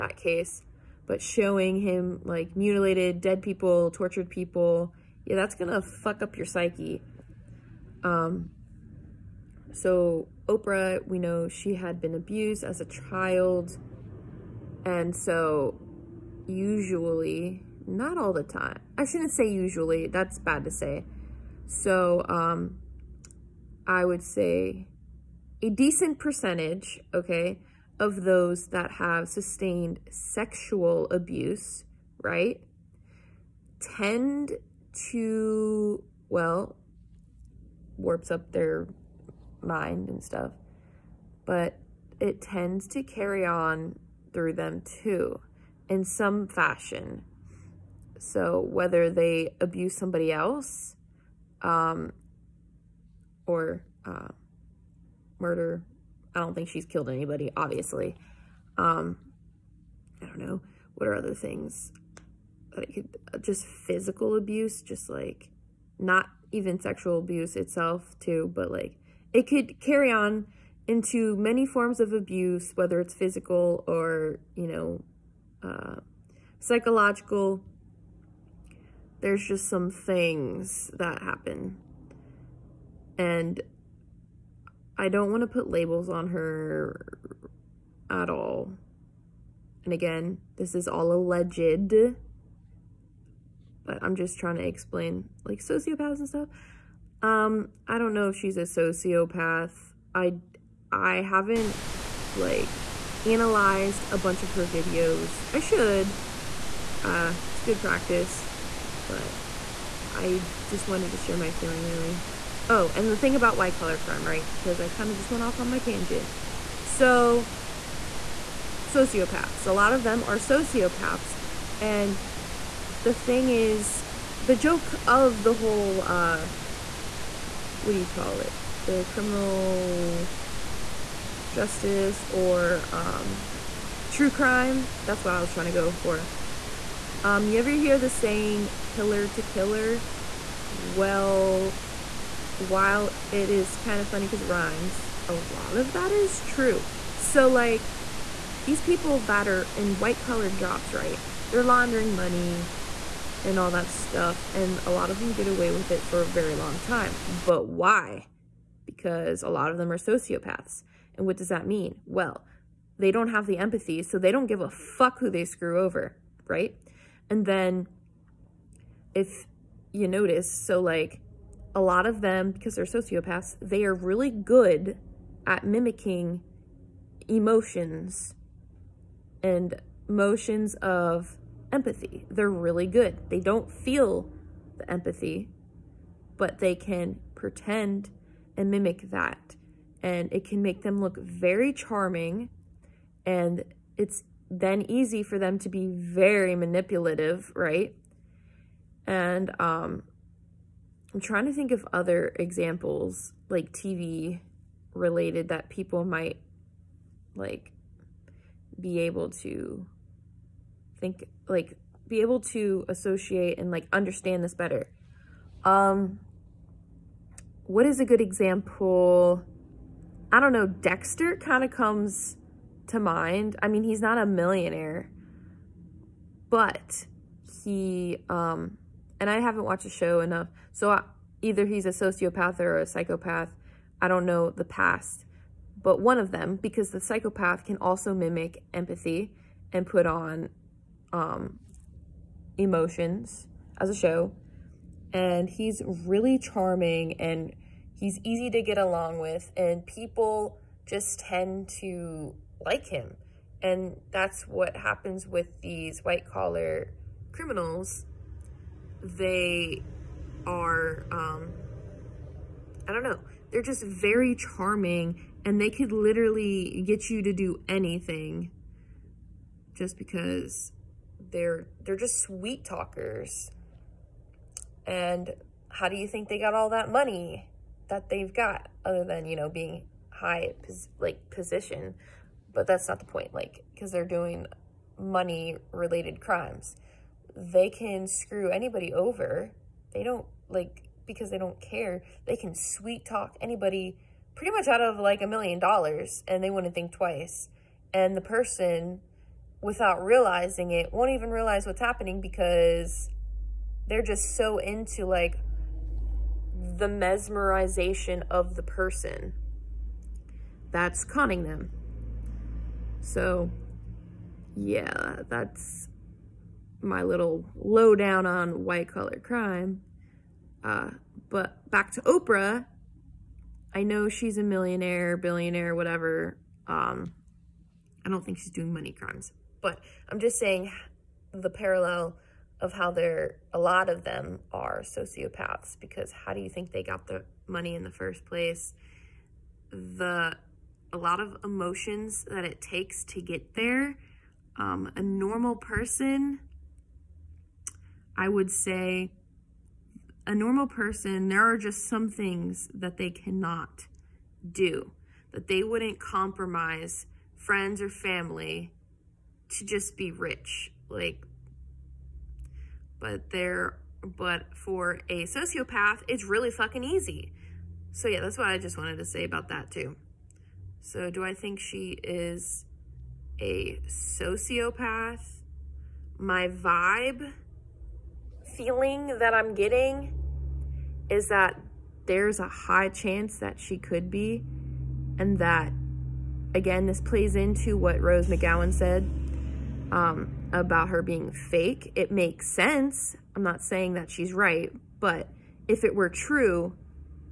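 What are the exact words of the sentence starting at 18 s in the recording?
I shouldn't say usually, that's bad to say.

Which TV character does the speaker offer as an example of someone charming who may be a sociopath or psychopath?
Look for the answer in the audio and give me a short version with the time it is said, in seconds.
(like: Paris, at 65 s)
Dexter, at 220 s.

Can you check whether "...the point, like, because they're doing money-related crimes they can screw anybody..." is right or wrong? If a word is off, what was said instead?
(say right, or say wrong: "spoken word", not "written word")
right.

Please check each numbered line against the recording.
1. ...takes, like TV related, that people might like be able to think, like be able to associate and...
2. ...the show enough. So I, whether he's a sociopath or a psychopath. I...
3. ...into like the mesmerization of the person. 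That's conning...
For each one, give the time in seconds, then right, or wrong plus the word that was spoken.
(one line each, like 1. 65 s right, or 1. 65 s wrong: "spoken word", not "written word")
1. 202 s wrong: "examples", not "takes"
2. 229 s wrong: "either", not "whether"
3. 304 s right.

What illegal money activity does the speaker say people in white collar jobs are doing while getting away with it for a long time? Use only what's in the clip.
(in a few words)
Laundering money.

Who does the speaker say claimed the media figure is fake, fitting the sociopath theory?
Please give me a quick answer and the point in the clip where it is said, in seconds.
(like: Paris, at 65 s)
Rose McGowan, at 387 s.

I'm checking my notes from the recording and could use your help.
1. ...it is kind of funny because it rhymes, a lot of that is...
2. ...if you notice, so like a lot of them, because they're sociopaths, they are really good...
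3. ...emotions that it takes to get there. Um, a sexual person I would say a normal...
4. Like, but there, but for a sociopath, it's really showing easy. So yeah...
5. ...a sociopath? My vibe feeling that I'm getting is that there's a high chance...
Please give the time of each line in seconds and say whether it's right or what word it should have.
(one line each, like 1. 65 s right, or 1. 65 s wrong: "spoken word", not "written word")
1. 143 s right
2. 169 s right
3. 341 s wrong: "normal", not "sexual"
4. 360 s wrong: "fucking", not "showing"
5. 373 s right.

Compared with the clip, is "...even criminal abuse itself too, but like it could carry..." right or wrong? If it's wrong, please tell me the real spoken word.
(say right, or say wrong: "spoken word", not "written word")
wrong: "sexual", not "criminal".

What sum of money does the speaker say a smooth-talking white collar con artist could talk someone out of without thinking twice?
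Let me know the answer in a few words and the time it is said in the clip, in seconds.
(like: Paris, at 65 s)
A million dollars, at 295 s.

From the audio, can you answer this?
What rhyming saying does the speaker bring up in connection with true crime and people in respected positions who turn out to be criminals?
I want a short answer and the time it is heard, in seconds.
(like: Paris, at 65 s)
Pillar to killer, at 138 s.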